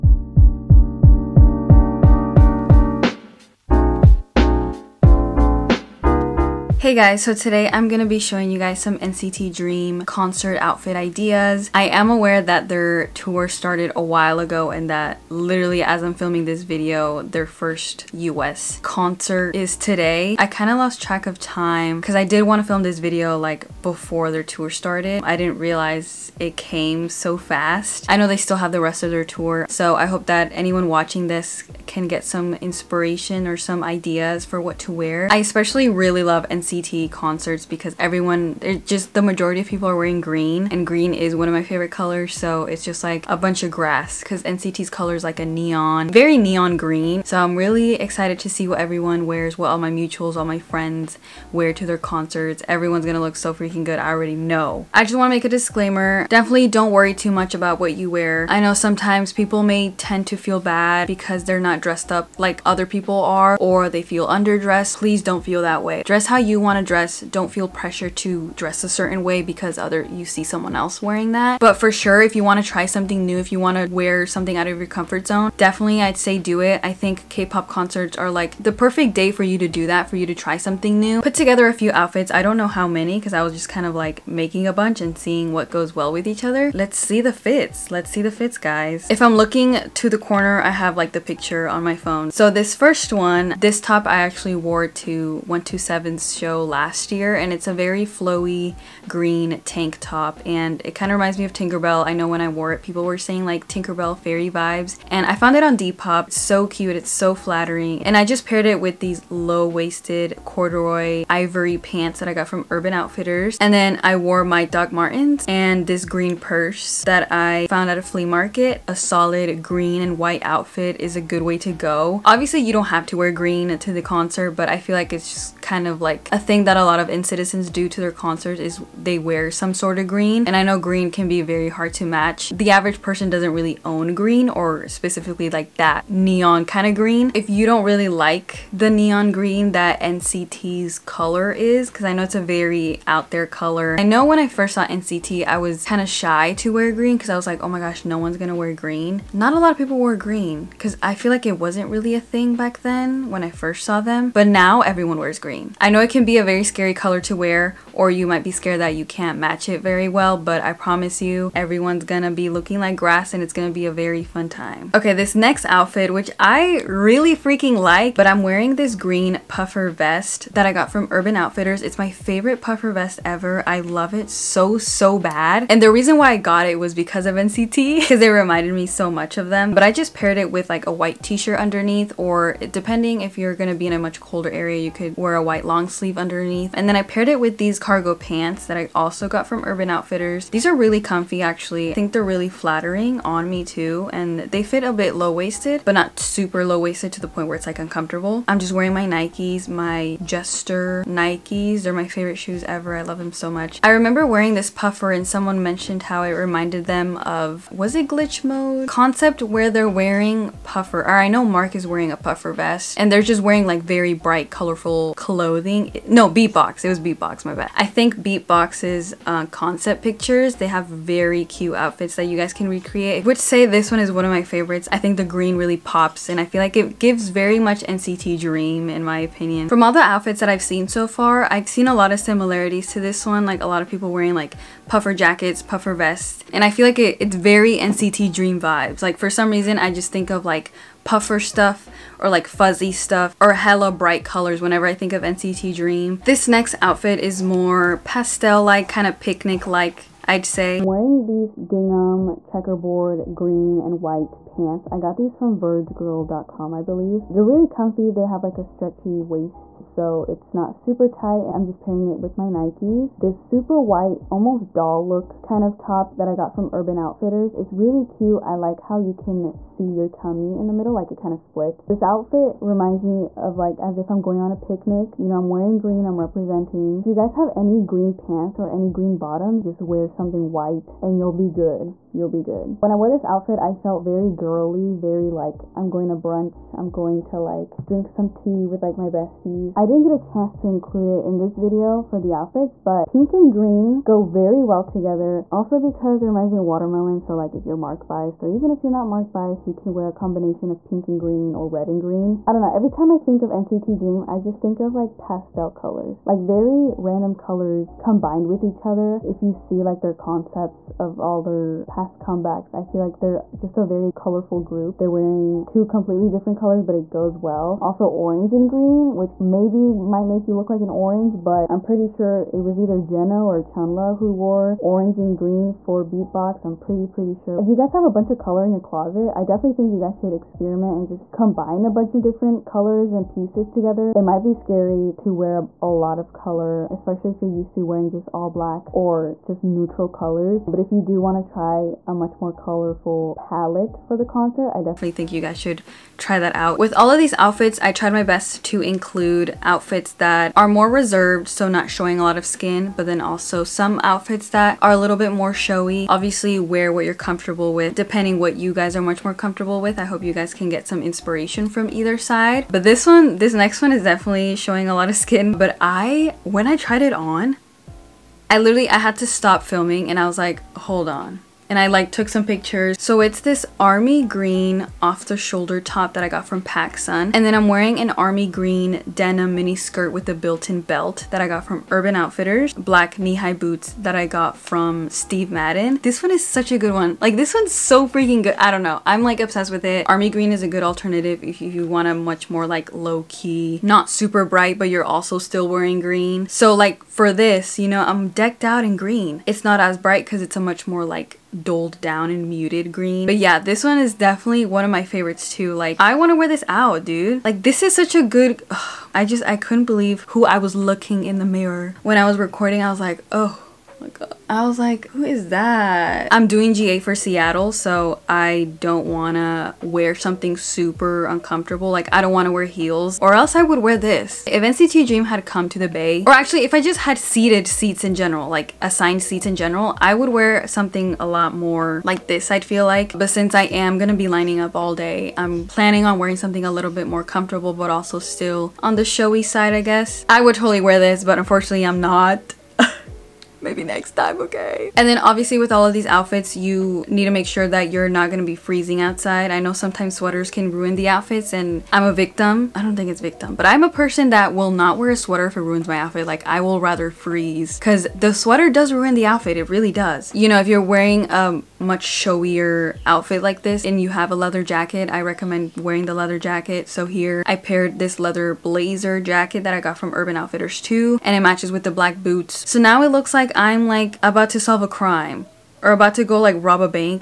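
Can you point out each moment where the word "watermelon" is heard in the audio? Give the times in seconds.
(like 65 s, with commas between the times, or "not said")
296 s.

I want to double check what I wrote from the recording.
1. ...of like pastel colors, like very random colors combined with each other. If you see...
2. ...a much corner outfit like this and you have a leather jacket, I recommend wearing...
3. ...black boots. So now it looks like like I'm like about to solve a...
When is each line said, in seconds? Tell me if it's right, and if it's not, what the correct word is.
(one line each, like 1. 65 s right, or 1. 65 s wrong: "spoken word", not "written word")
1. 304 s right
2. 461 s wrong: "showier", not "corner"
3. 471 s right.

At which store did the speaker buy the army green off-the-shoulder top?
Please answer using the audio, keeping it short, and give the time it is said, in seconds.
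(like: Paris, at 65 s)
PacSun, at 376 s.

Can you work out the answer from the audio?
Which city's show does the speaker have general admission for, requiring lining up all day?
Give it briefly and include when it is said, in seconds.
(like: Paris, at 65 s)
Seattle, at 417 s.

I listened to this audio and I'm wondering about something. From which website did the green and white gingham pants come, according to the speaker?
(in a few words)
vergegirl.com.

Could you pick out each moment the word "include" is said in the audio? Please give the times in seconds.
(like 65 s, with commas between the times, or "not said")
290 s, 348 s.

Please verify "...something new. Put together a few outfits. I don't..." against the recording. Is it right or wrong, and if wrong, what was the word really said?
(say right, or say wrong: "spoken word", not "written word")
right.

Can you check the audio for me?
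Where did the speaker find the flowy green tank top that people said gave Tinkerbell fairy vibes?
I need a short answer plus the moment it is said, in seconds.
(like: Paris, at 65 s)
Depop, at 105 s.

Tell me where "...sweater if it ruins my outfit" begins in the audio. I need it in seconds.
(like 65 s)
455 s.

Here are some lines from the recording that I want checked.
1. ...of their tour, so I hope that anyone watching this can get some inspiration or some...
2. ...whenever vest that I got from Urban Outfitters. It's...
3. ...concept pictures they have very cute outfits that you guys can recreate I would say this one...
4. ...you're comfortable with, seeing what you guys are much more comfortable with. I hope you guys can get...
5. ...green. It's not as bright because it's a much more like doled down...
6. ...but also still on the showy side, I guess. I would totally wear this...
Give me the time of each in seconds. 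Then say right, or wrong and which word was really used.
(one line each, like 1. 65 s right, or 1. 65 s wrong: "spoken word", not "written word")
1. 29 s right
2. 169 s wrong: "puffer", not "whenever"
3. 219 s right
4. 357 s wrong: "depending", not "seeing"
5. 398 s right
6. 437 s right.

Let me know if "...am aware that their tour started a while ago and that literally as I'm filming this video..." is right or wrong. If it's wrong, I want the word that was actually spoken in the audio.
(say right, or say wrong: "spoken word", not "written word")
right.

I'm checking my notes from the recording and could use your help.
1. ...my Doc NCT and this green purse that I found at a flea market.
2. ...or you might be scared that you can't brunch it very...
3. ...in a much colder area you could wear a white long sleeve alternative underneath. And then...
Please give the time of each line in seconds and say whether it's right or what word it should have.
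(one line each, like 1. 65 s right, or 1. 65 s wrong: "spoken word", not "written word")
1. 114 s wrong: "Martens", not "NCT"
2. 157 s wrong: "match", not "brunch"
3. 183 s wrong: "sleeve", not "alternative".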